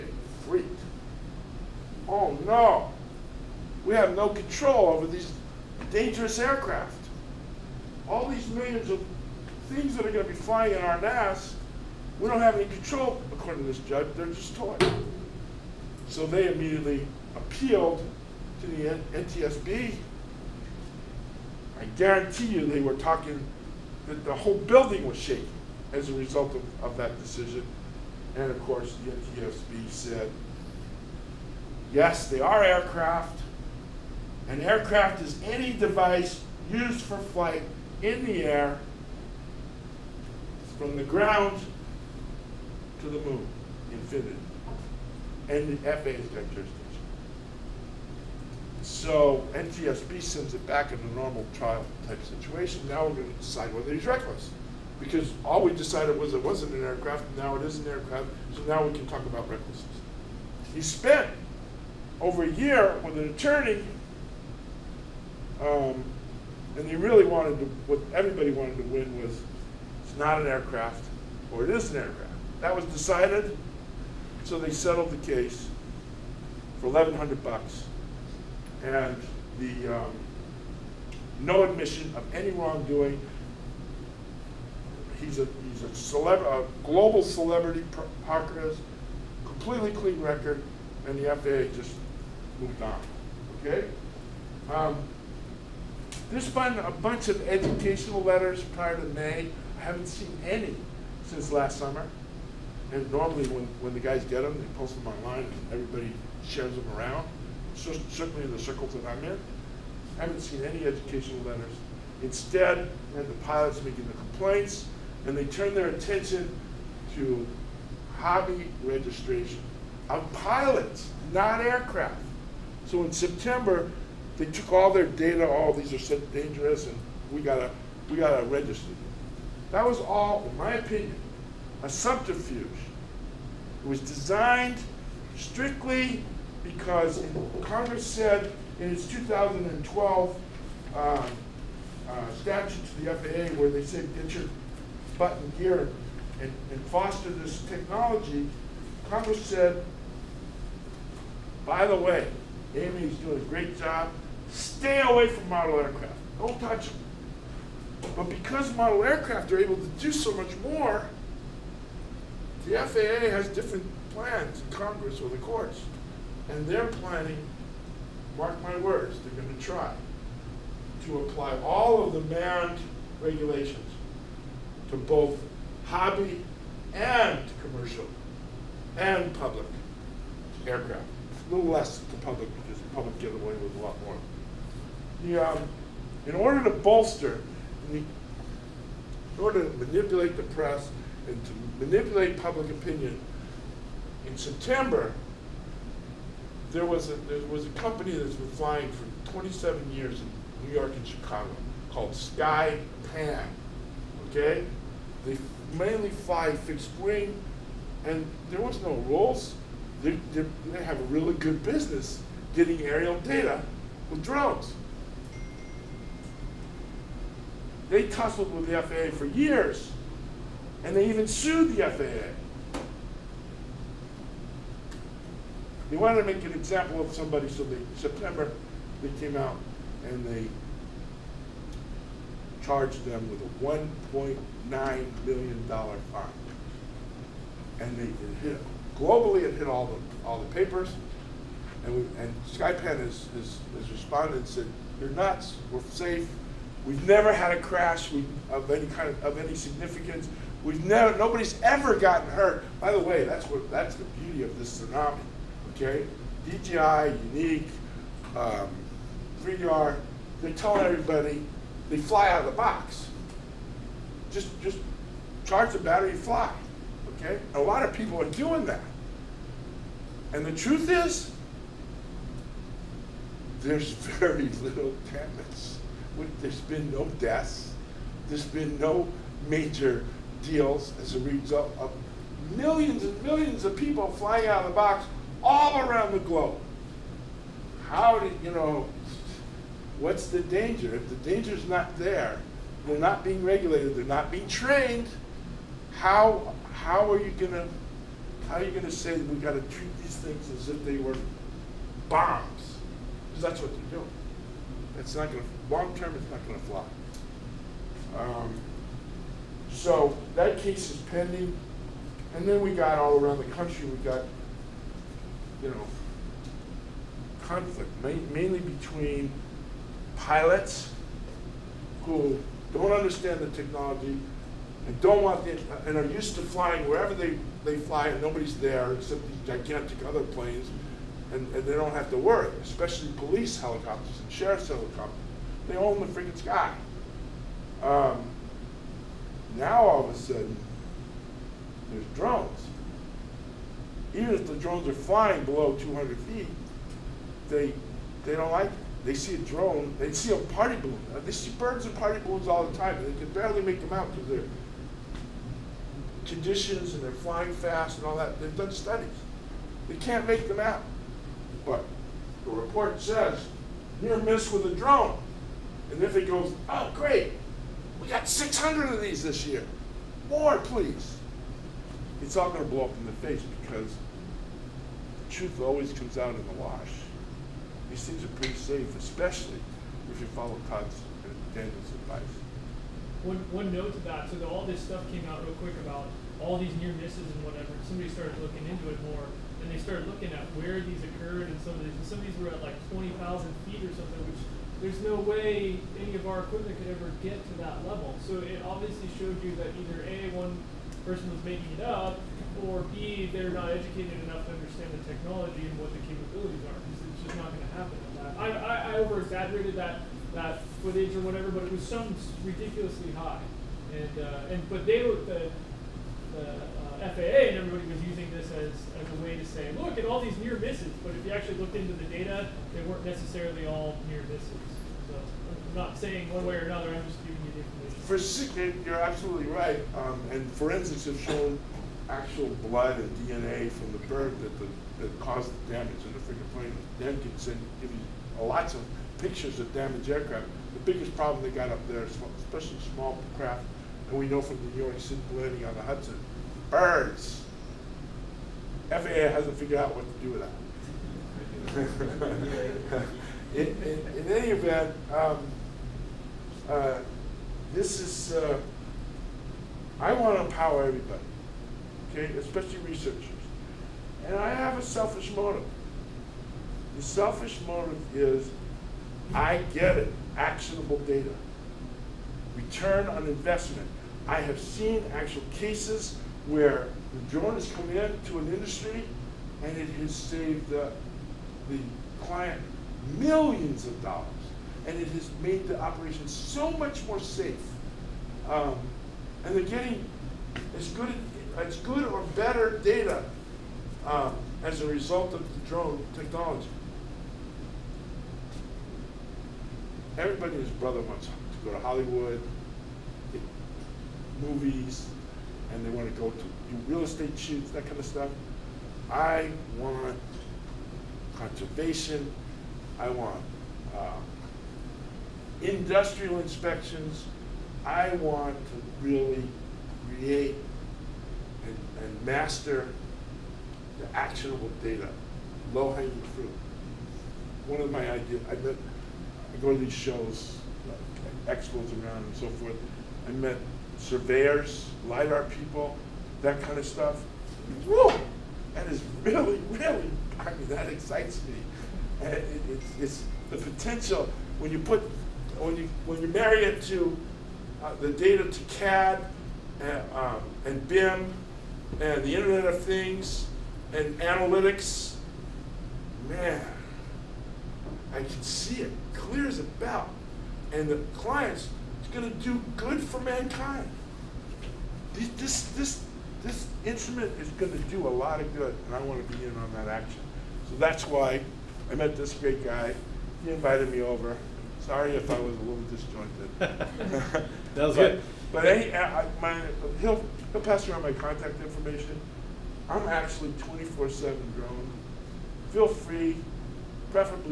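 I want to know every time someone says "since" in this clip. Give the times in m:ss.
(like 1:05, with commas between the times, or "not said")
1:41.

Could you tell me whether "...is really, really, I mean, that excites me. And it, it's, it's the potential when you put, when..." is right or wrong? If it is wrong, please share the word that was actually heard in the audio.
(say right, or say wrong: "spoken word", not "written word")
right.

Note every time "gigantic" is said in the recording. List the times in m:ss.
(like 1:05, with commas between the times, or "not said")
5:29.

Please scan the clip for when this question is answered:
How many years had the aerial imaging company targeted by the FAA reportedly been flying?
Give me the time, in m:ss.
3:19.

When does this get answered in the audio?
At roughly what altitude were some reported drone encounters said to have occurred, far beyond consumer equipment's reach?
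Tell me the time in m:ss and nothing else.
6:32.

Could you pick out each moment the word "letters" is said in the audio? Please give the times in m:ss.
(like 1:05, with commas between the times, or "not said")
1:38, 1:51.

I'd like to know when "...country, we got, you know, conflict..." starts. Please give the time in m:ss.
5:13.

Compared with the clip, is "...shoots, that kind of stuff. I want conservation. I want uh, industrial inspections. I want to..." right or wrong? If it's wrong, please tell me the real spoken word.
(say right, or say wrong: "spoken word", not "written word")
right.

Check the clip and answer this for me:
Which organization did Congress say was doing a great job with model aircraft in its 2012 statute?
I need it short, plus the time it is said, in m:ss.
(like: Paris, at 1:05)
AMA, at 2:32.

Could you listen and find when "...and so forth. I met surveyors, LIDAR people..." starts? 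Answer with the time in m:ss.
8:52.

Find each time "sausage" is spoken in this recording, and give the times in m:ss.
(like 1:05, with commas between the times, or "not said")
not said.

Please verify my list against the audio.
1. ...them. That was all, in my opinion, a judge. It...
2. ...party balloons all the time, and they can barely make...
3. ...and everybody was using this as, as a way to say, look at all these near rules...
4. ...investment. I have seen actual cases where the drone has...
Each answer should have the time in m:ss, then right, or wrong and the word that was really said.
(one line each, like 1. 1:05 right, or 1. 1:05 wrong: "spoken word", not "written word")
1. 2:08 wrong: "subterfuge", not "judge"
2. 5:51 right
3. 6:57 wrong: "misses", not "rules"
4. 7:53 right.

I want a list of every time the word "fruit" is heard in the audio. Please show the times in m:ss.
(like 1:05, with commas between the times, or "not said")
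8:46.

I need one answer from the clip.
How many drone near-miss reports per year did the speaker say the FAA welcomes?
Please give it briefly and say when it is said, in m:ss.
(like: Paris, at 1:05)
600, at 6:08.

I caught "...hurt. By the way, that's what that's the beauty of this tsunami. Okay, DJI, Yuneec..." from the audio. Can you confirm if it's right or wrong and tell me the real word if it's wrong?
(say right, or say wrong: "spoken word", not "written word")
right.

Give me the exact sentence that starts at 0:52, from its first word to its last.
Now we're going to decide whether he's reckless.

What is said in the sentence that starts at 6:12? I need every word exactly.
It's all going to blow up in the face because the truth always comes out in the wash.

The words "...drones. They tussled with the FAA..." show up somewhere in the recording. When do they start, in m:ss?
3:34.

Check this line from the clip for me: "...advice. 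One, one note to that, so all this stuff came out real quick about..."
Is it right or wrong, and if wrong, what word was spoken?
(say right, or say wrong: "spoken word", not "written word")
right.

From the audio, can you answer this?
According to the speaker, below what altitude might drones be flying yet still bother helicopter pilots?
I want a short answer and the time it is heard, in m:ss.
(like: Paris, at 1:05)
200 feet, at 5:45.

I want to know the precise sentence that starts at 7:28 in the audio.
FAA hasn't figured out what to do with that.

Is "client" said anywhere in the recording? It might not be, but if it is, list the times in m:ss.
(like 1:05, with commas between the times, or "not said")
8:02, 9:21.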